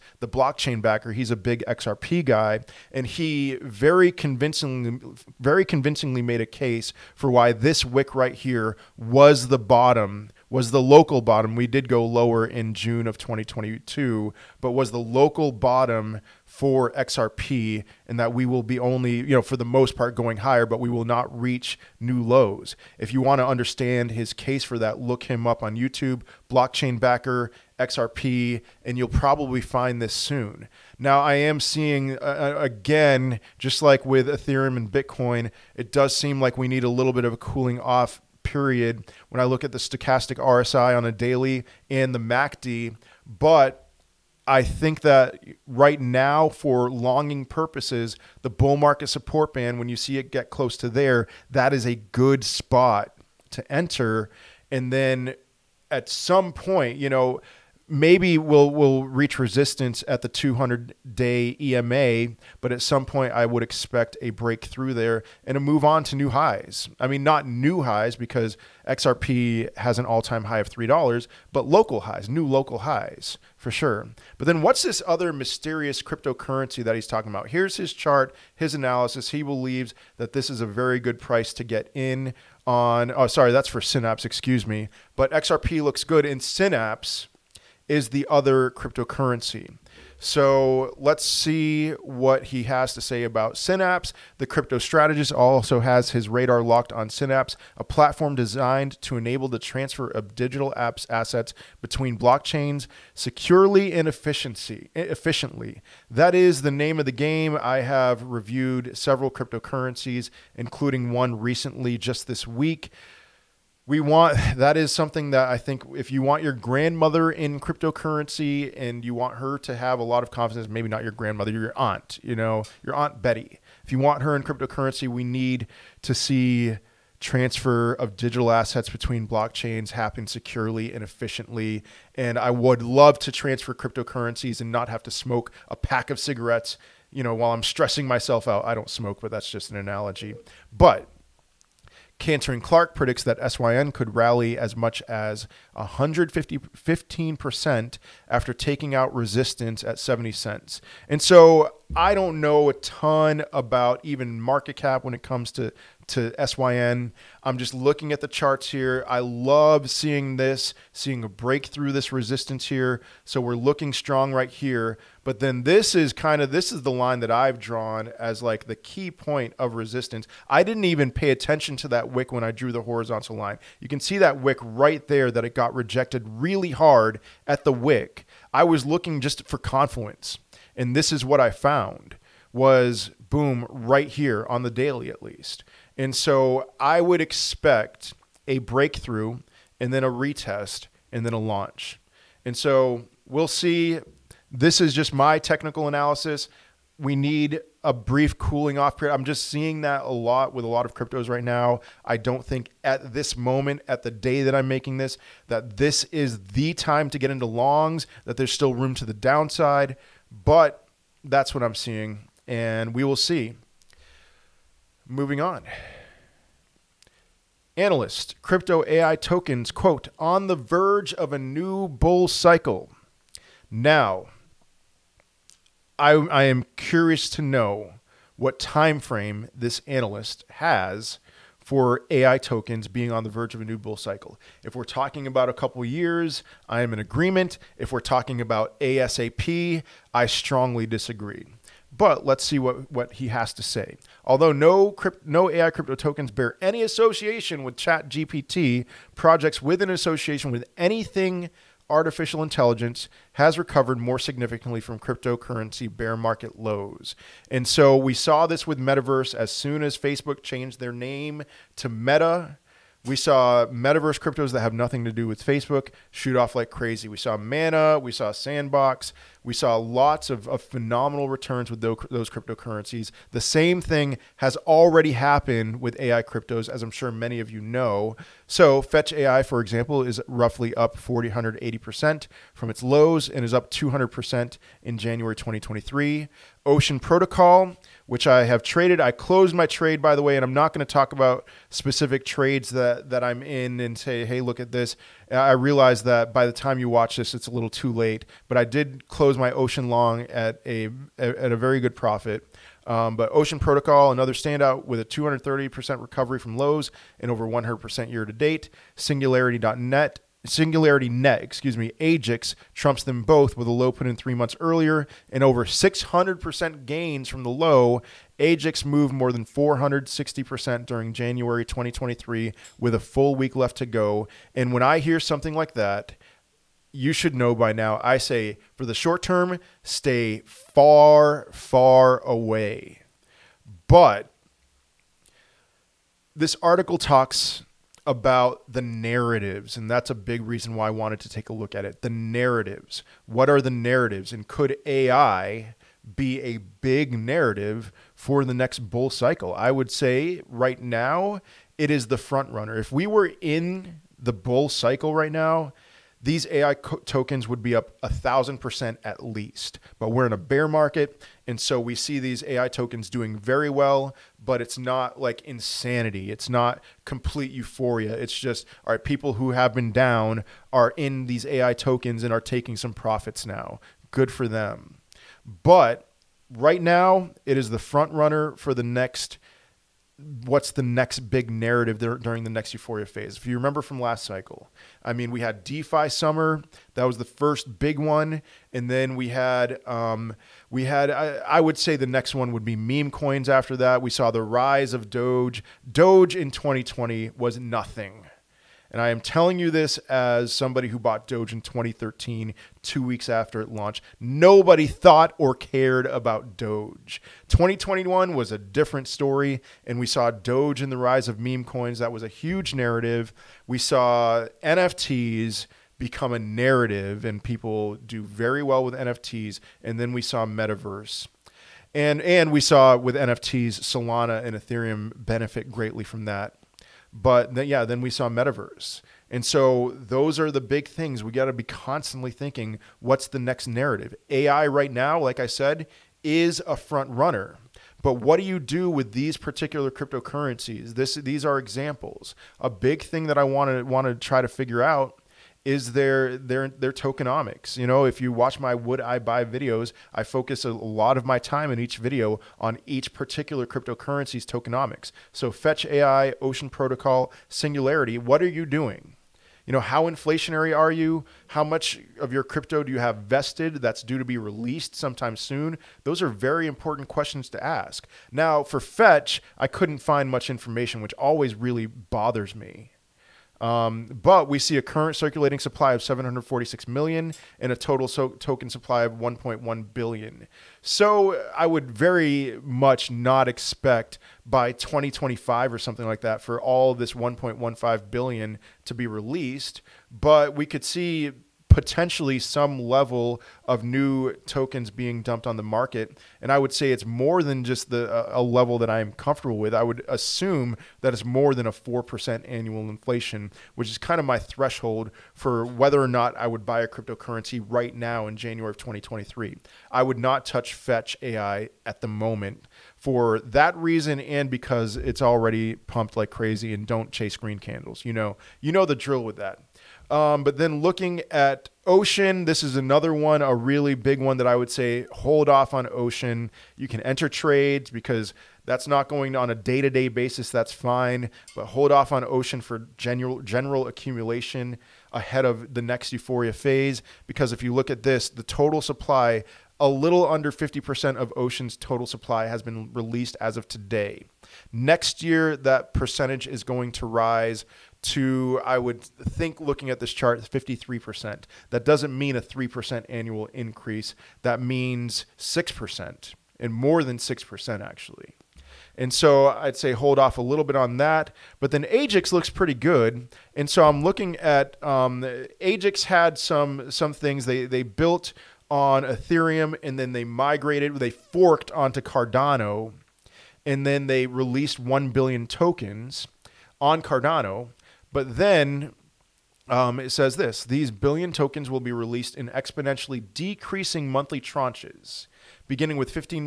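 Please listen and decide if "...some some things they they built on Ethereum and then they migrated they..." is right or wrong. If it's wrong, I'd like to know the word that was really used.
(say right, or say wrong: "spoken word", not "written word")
right.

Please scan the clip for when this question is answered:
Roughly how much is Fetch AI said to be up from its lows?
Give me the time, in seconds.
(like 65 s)
280 s.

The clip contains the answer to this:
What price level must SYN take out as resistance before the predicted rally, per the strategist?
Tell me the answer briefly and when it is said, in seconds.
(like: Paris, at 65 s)
70 cents, at 149 s.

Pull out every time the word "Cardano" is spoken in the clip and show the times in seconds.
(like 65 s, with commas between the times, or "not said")
571 s, 577 s.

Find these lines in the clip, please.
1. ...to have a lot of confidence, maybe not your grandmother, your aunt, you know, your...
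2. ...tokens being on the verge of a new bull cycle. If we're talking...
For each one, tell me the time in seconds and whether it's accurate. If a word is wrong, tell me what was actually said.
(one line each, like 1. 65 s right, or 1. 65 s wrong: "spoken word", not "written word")
1. 119 s right
2. 232 s right.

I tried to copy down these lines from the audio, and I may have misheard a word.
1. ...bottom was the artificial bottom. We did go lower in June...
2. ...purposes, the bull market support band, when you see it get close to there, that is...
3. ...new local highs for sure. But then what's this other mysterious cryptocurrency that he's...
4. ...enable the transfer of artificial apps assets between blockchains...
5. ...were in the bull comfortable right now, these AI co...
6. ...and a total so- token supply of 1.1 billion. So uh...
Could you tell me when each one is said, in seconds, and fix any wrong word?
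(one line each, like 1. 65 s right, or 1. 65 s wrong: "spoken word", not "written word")
1. 9 s wrong: "local", not "artificial"
2. 47 s right
3. 72 s right
4. 99 s wrong: "digital", not "artificial"
5. 353 s wrong: "cycle", not "comfortable"
6. 477 s right.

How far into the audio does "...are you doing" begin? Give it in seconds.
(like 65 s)
458 s.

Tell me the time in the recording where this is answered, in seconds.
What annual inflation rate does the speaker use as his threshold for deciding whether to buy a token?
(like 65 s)
501 s.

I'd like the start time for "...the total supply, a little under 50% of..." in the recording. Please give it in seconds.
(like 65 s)
538 s.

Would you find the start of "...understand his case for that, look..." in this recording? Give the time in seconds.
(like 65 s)
23 s.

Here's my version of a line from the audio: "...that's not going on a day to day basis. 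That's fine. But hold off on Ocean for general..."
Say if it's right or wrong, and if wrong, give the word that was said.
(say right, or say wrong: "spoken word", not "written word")
right.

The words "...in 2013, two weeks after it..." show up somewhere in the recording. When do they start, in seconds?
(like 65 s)
401 s.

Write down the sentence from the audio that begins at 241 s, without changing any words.
But let's see what, what he has to say.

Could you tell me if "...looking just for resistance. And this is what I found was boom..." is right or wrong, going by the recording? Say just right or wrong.
wrong.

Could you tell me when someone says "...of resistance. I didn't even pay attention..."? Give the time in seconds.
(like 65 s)
169 s.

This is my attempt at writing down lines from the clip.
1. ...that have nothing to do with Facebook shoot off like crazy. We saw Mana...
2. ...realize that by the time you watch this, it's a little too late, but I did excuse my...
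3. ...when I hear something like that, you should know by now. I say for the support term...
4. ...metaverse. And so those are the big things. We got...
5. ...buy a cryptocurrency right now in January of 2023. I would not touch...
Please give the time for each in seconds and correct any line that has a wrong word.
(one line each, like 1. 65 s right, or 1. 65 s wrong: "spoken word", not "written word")
1. 264 s right
2. 295 s wrong: "close", not "excuse"
3. 324 s wrong: "short", not "support"
4. 428 s right
5. 506 s right.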